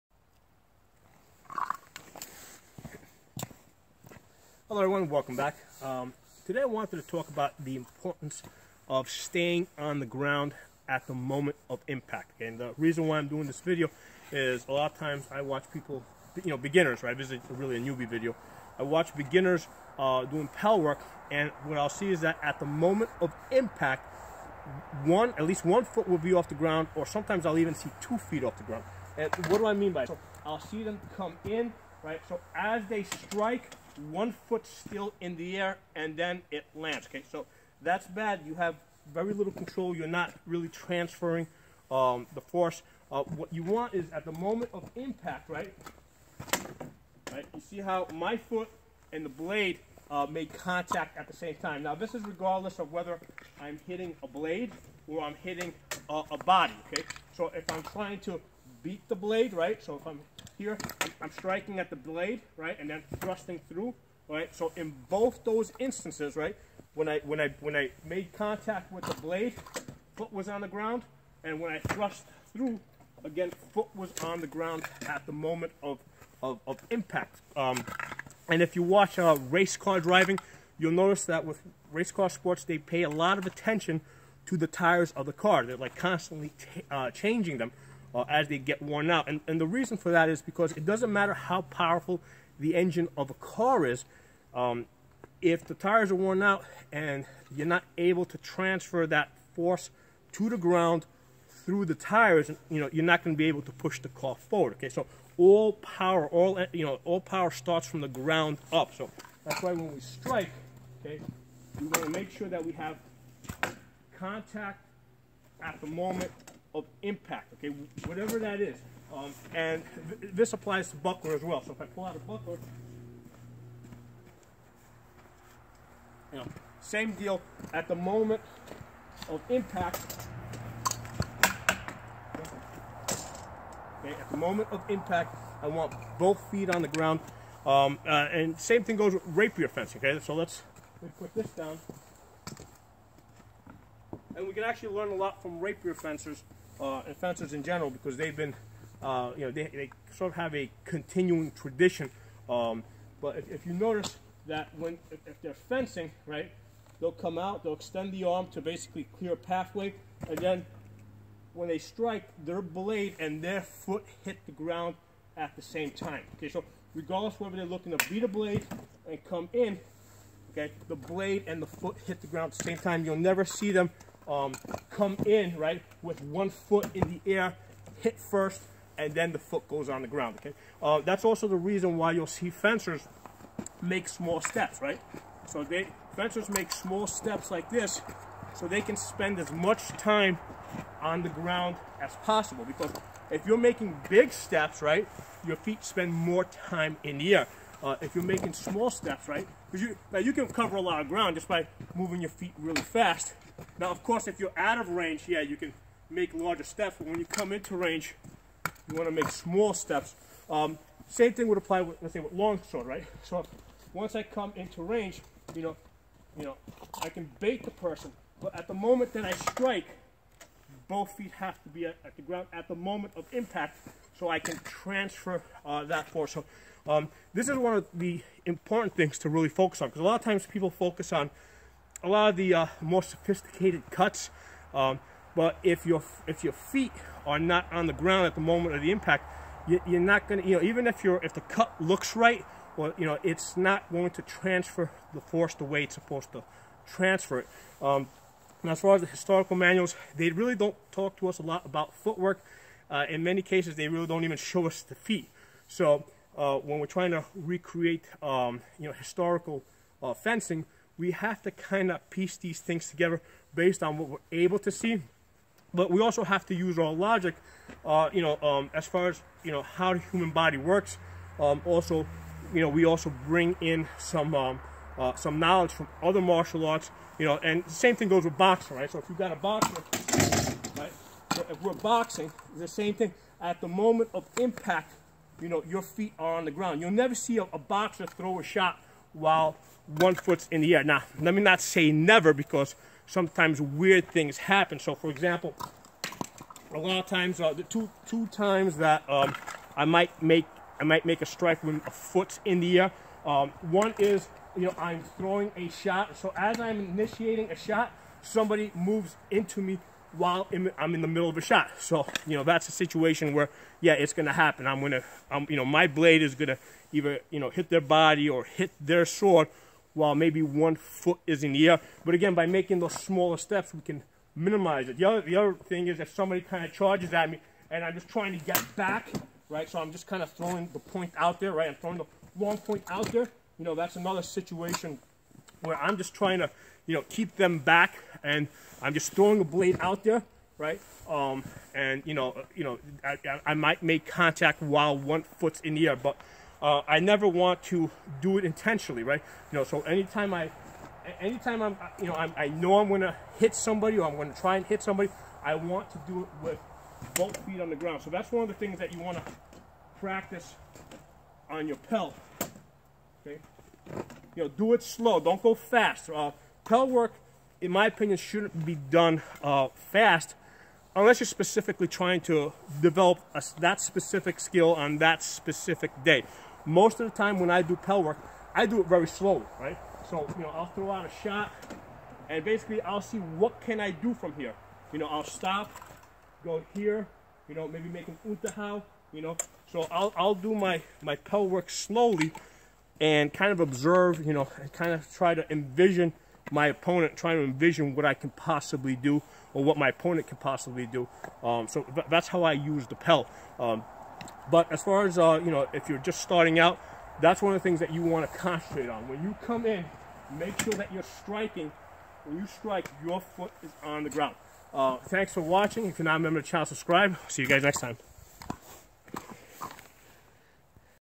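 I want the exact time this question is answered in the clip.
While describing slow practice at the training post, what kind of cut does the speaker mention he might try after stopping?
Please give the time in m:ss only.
6:28.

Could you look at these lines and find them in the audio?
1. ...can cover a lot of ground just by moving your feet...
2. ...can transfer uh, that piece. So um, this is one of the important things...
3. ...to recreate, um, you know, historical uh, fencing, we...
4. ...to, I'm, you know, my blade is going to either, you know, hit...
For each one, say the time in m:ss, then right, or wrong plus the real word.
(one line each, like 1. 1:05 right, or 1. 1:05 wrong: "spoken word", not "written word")
1. 3:20 right
2. 3:44 wrong: "force", not "piece"
3. 4:17 right
4. 5:14 right.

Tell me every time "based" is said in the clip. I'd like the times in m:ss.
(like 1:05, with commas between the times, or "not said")
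4:23.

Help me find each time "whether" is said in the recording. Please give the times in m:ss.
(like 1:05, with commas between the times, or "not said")
0:52, 2:47.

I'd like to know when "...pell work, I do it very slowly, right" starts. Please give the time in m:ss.
6:17.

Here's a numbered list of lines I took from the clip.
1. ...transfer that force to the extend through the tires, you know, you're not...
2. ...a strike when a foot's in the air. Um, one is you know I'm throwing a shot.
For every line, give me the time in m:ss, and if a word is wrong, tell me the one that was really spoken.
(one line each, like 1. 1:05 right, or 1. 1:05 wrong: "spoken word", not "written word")
1. 1:38 wrong: "ground", not "extend"
2. 5:01 right.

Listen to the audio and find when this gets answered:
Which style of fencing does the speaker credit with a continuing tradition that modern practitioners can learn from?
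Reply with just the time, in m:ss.
2:19.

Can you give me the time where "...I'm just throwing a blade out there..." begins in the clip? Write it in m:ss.
5:38.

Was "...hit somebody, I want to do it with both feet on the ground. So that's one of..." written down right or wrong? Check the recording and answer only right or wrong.
right.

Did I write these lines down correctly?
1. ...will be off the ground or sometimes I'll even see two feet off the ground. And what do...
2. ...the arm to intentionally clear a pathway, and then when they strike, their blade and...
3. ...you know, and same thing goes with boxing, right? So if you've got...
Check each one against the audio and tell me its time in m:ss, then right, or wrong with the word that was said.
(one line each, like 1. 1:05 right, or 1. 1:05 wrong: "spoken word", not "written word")
1. 0:26 right
2. 2:38 wrong: "basically", not "intentionally"
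3. 4:37 right.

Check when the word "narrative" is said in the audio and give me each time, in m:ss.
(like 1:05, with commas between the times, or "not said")
not said.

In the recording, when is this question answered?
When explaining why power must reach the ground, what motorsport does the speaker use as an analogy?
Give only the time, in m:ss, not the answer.
1:19.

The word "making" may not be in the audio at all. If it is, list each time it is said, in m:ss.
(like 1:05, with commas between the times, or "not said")
3:13, 3:18, 5:22.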